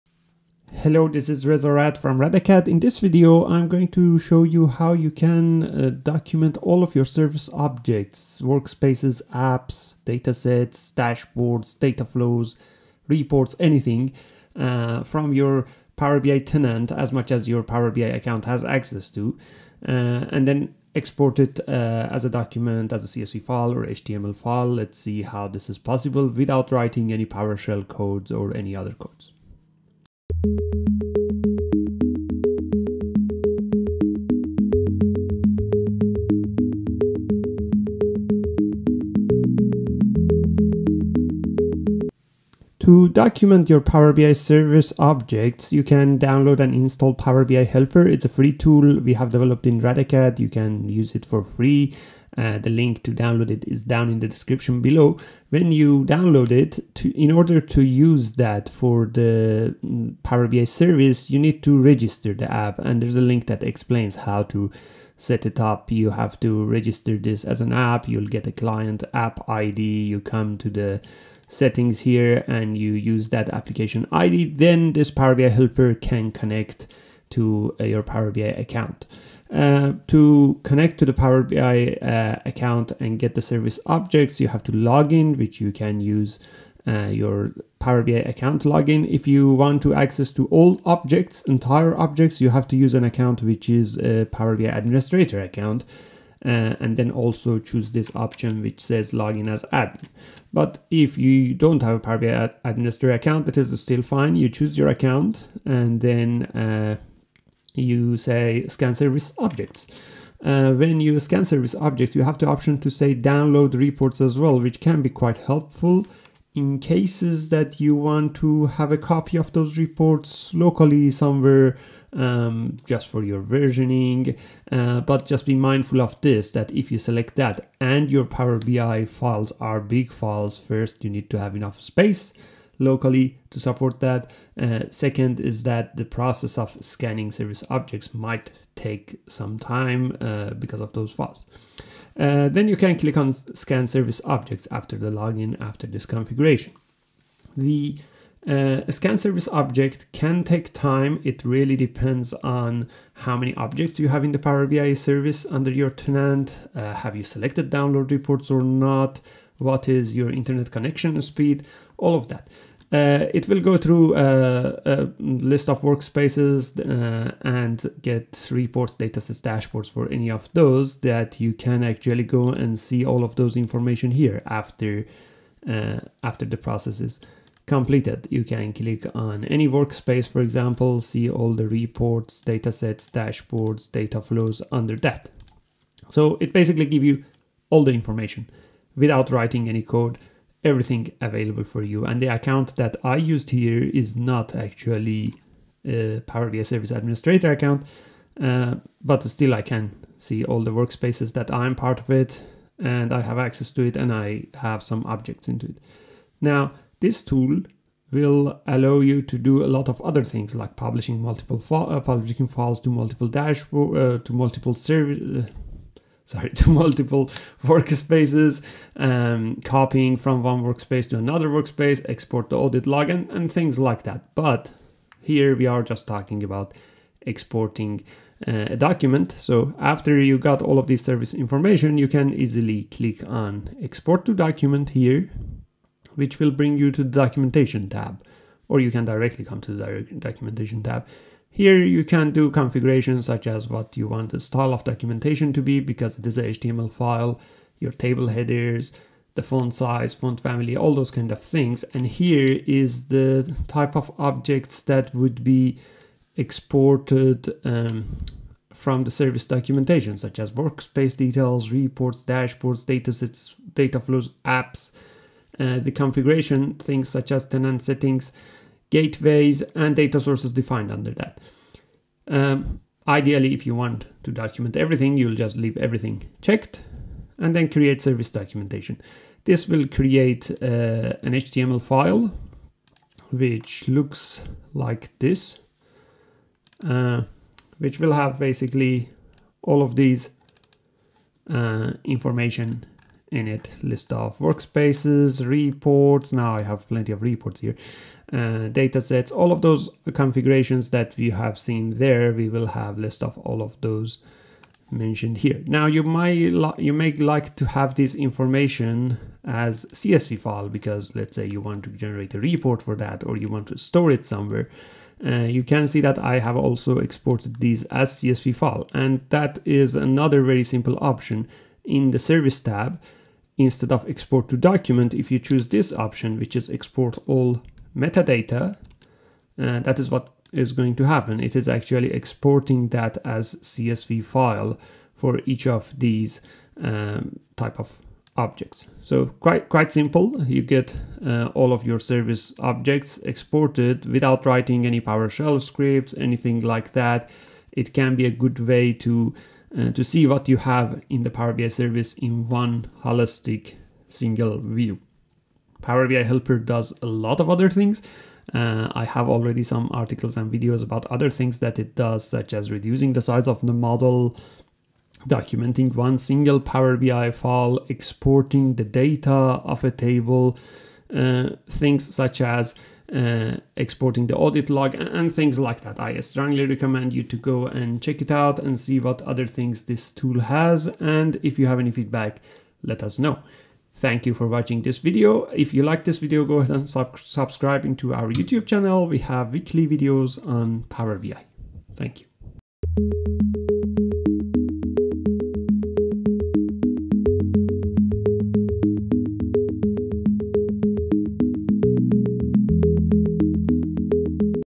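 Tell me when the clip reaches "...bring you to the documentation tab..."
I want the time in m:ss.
3:56.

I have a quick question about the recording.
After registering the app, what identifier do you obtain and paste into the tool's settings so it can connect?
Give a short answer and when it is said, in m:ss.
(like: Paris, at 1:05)
client app ID, at 1:08.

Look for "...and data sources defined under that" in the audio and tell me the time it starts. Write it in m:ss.
4:29.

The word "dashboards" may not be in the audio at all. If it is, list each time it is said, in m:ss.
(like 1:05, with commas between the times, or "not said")
0:10, 2:49, 3:03, 3:33, 4:22.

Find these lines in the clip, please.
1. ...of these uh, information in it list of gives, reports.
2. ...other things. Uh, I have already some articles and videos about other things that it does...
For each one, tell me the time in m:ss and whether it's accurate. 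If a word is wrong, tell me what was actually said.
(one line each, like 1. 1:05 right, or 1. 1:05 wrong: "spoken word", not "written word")
1. 4:49 wrong: "workspaces", not "gives"
2. 5:57 right.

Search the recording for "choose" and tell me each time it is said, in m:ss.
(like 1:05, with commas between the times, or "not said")
1:37, 1:44, 5:25.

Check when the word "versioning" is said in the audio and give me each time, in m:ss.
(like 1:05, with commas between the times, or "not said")
2:03.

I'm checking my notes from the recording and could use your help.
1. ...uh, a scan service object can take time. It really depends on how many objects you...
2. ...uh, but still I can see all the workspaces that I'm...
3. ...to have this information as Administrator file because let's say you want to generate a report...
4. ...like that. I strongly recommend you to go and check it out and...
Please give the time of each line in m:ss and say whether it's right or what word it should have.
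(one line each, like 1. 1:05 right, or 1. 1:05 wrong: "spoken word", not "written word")
1. 2:28 right
2. 3:18 right
3. 5:07 wrong: "CSV", not "Administrator"
4. 6:15 right.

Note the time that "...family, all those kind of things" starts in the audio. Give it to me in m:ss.
4:10.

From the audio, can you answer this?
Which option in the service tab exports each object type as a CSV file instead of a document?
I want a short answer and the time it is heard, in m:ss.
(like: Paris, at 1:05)
export all metadata, at 5:26.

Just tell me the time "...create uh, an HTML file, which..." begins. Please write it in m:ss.
4:39.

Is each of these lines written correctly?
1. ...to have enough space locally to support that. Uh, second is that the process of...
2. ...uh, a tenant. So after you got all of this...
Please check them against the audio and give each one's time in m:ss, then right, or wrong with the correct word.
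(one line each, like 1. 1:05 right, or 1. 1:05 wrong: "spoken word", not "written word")
1. 2:11 right
2. 3:48 wrong: "document", not "tenant".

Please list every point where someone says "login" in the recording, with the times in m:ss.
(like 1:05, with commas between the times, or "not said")
1:28, 1:39, 2:25.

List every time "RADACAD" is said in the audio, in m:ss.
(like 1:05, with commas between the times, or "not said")
0:02, 0:49.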